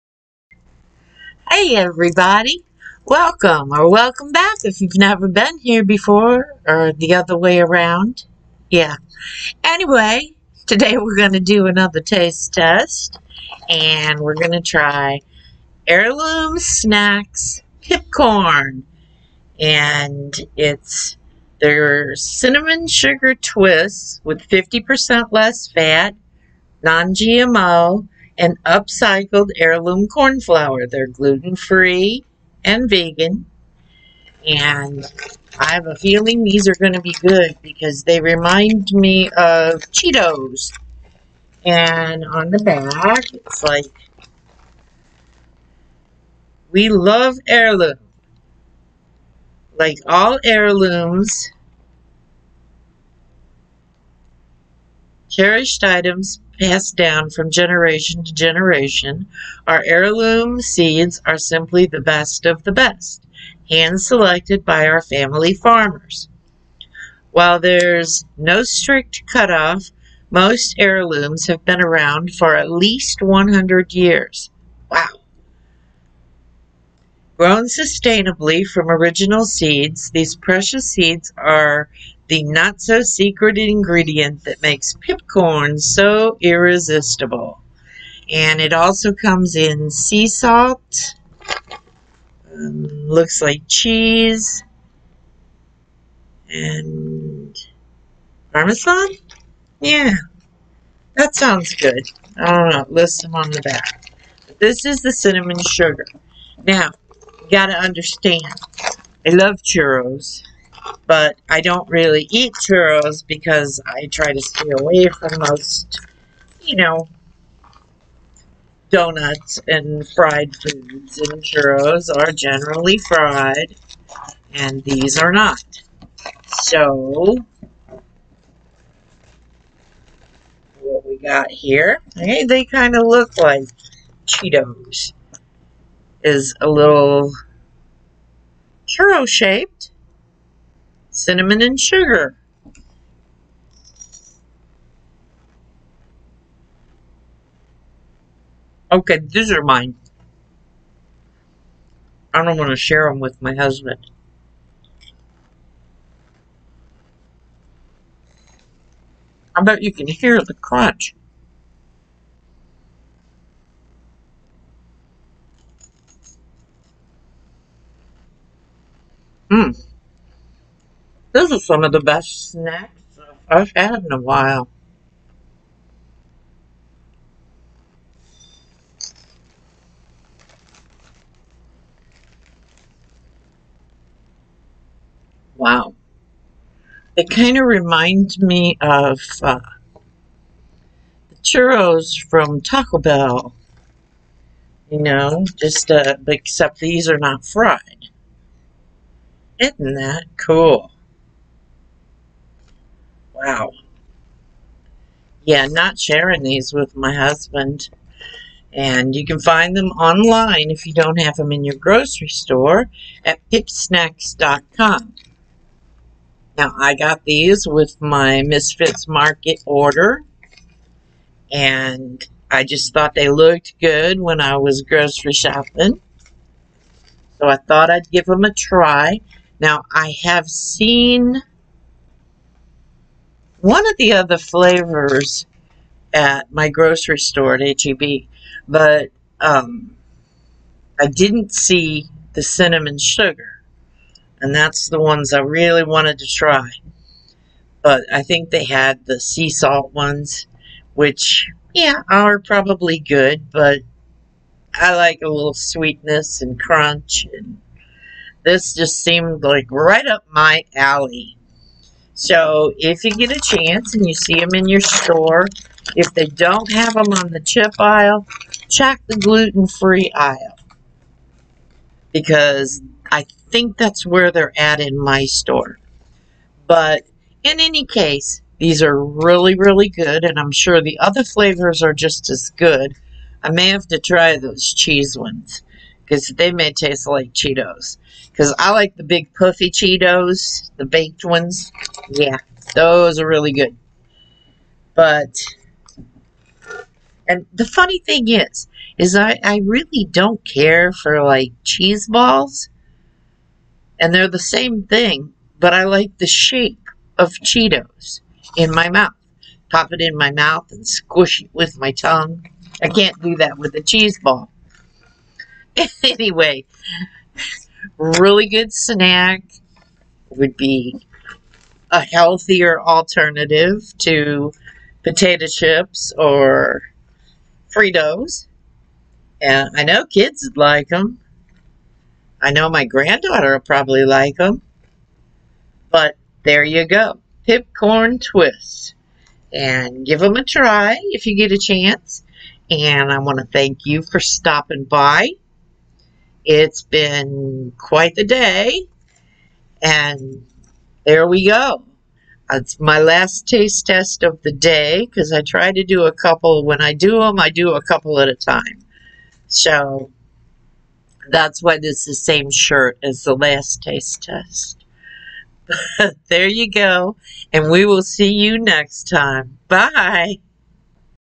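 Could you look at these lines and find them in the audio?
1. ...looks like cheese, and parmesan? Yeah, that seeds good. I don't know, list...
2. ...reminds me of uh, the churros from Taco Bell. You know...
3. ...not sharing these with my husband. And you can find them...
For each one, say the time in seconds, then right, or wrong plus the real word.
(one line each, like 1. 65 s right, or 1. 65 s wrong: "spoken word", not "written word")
1. 93 s wrong: "sounds", not "seeds"
2. 187 s right
3. 205 s right.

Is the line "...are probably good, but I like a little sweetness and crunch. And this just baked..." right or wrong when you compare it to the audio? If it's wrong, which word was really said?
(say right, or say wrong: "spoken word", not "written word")
wrong: "seemed", not "baked".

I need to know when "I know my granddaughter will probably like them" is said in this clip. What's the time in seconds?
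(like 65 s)
332 s.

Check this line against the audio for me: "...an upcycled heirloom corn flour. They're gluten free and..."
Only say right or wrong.
right.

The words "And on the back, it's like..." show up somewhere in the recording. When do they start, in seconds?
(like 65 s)
41 s.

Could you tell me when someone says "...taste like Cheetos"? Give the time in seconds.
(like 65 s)
286 s.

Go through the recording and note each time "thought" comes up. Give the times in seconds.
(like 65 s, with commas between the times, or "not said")
222 s, 227 s.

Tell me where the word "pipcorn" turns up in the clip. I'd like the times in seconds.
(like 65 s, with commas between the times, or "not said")
17 s, 85 s, 337 s.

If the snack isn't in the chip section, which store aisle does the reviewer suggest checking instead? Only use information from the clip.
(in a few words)
gluten-free aisle.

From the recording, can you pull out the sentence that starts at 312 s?
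I can't do that with a cheese ball.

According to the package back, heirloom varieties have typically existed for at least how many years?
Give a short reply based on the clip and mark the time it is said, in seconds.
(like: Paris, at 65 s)
100, at 73 s.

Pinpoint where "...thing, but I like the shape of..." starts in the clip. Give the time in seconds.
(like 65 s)
304 s.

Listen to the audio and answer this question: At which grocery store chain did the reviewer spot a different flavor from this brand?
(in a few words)
HEB.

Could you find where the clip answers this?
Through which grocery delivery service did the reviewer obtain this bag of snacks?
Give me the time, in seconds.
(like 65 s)
218 s.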